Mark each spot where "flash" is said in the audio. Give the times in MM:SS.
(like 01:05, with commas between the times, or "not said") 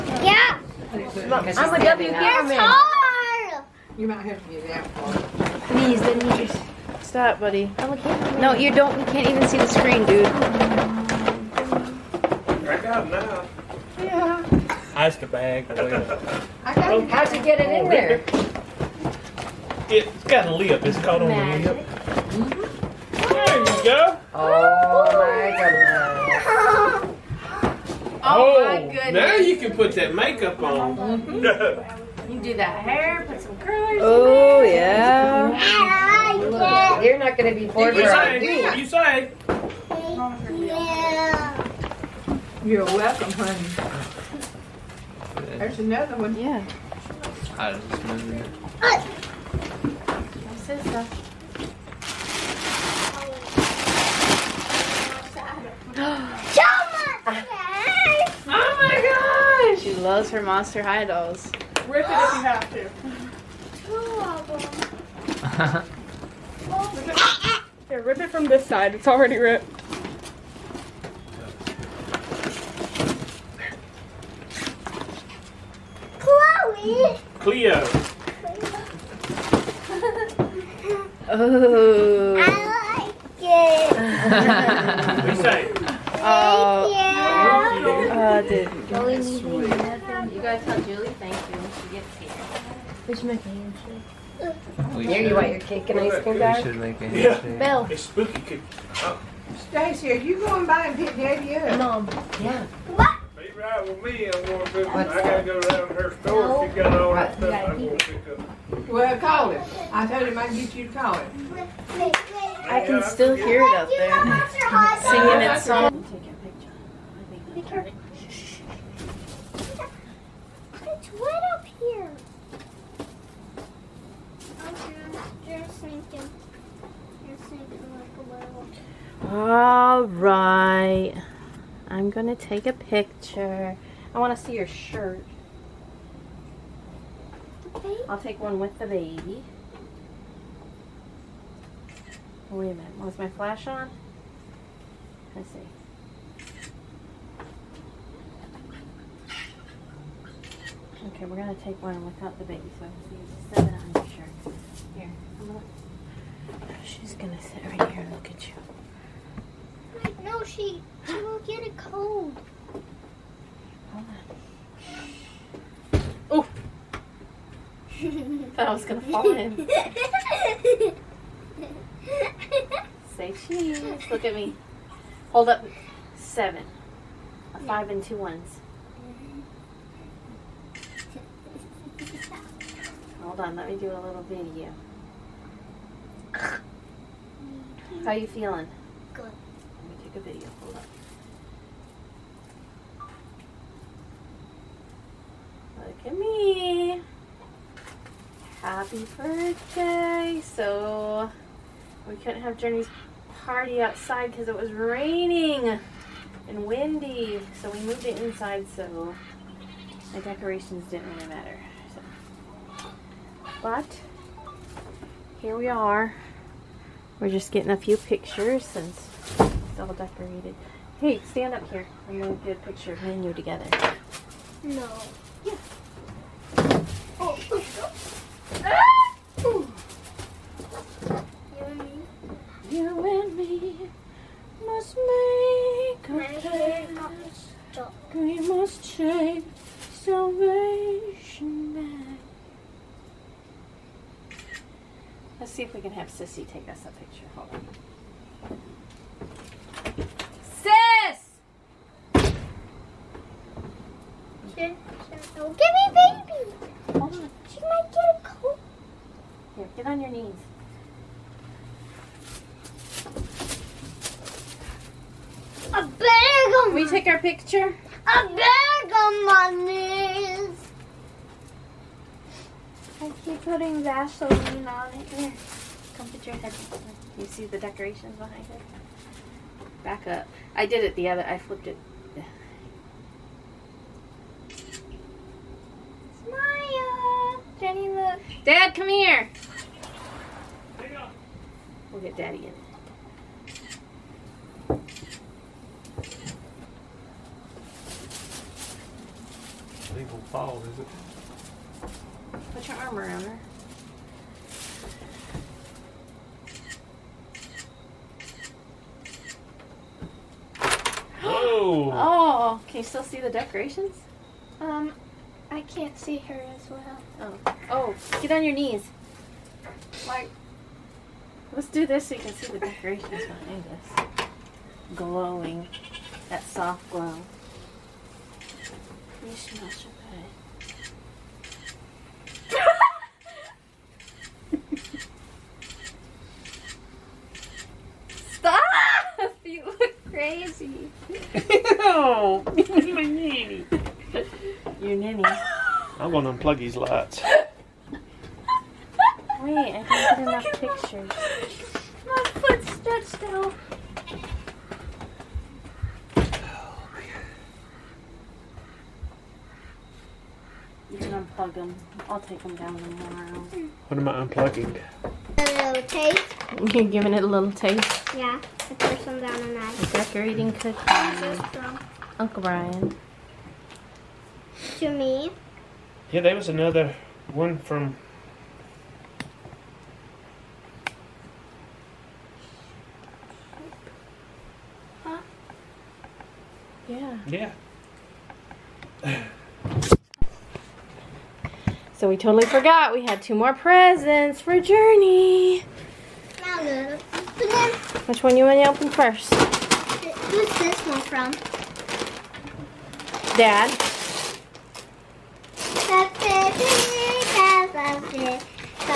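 02:23.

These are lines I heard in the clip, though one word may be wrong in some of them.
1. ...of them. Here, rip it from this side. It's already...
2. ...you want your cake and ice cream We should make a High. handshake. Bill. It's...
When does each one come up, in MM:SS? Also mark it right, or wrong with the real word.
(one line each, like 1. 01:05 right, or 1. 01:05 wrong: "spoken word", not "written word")
1. 01:04 right
2. 01:35 wrong: "Yeah", not "High".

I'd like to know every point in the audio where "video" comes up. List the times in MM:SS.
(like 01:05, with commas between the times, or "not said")
03:04, 03:10.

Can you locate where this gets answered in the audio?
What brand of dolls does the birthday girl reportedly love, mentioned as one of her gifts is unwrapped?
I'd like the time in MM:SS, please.
01:00.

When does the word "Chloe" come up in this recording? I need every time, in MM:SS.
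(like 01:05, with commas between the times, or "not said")
01:16.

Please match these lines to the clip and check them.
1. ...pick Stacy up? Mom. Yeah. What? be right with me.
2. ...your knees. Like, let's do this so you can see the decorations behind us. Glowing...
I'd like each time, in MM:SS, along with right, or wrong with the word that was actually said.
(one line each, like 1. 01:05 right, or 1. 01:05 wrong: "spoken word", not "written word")
1. 01:40 wrong: "Daddy", not "Stacy"
2. 05:18 right.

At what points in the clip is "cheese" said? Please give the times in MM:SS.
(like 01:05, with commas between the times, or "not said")
02:53.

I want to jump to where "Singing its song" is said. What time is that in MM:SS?
01:55.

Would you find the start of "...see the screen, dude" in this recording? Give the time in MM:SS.
00:09.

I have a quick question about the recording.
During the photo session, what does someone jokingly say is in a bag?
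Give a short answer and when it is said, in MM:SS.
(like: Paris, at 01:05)
A bag of money, at 04:28.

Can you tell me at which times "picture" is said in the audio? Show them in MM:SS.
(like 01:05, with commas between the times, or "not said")
02:12, 03:37, 03:42, 04:06, 04:27, 05:50.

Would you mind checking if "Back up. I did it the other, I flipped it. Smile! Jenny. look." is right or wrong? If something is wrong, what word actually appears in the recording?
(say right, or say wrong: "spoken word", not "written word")
right.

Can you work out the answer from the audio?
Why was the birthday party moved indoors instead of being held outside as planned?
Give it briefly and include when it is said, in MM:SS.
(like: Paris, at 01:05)
raining and windy, at 03:24.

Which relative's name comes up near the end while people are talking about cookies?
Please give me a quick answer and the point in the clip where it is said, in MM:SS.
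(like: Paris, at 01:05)
Uncle Brian, at 06:12.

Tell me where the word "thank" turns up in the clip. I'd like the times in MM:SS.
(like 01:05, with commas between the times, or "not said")
01:26, 01:31.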